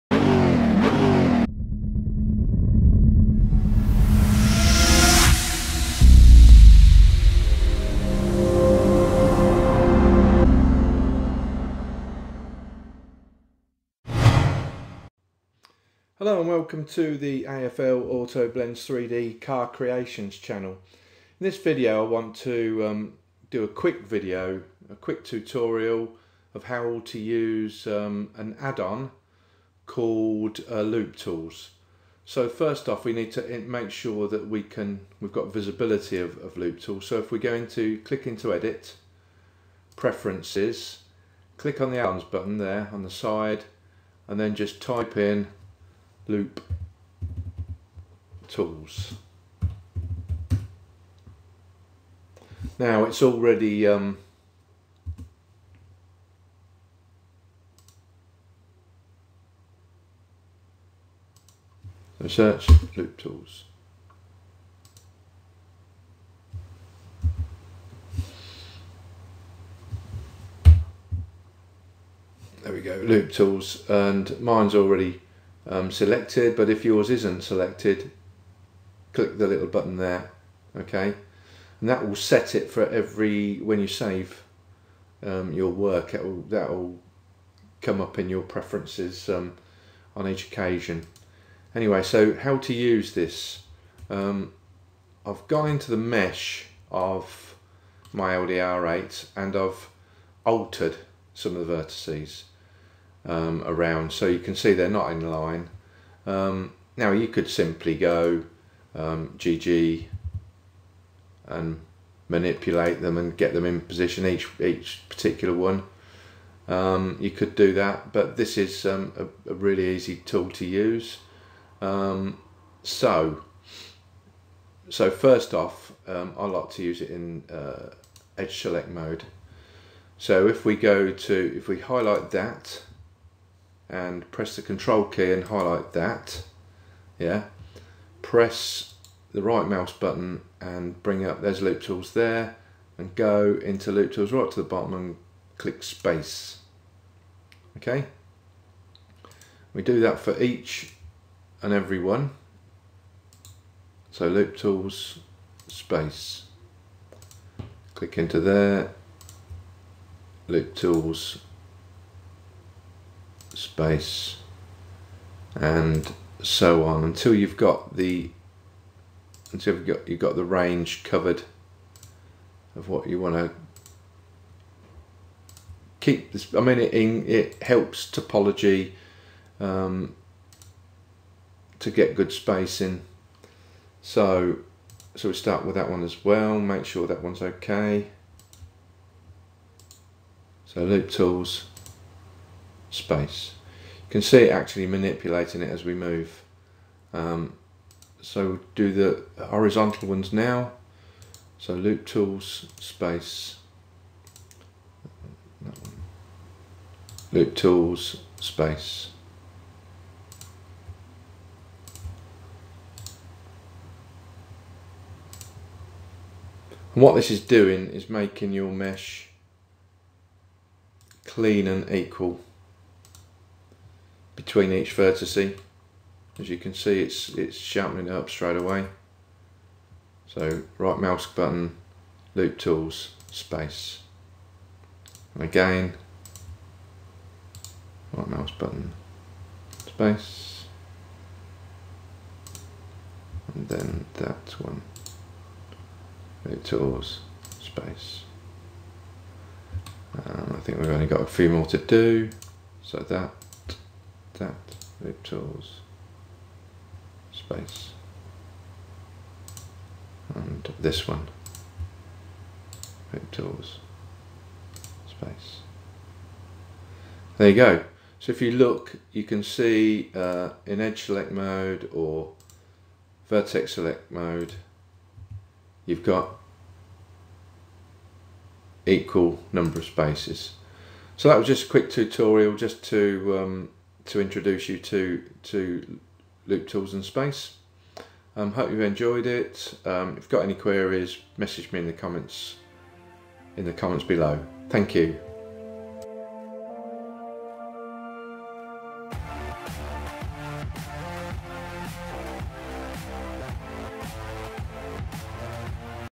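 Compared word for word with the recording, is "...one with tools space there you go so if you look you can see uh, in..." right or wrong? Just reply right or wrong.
right.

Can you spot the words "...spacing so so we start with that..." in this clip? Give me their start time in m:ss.
3:02.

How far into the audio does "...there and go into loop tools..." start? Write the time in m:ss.
2:22.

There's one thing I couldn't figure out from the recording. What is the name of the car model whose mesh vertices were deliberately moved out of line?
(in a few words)
LDR8.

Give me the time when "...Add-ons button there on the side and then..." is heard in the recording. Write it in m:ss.
0:41.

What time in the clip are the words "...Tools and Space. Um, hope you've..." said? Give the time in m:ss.
4:46.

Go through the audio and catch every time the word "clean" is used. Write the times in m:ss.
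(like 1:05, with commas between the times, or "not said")
3:41.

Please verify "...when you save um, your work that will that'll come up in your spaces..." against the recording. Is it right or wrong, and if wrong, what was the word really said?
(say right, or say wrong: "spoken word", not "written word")
wrong: "preferences", not "spaces".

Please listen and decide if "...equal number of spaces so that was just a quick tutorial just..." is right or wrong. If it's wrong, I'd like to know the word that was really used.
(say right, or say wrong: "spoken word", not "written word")
right.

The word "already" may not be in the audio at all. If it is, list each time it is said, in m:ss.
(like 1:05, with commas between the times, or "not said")
0:53, 1:14.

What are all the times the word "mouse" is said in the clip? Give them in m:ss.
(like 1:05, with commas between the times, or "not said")
2:19, 3:50, 3:58.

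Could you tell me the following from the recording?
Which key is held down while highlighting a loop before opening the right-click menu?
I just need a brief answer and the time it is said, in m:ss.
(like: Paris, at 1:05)
control key, at 2:14.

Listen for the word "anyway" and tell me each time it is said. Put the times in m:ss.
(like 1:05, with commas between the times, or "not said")
1:31.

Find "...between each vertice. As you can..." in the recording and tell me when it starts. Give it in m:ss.
3:44.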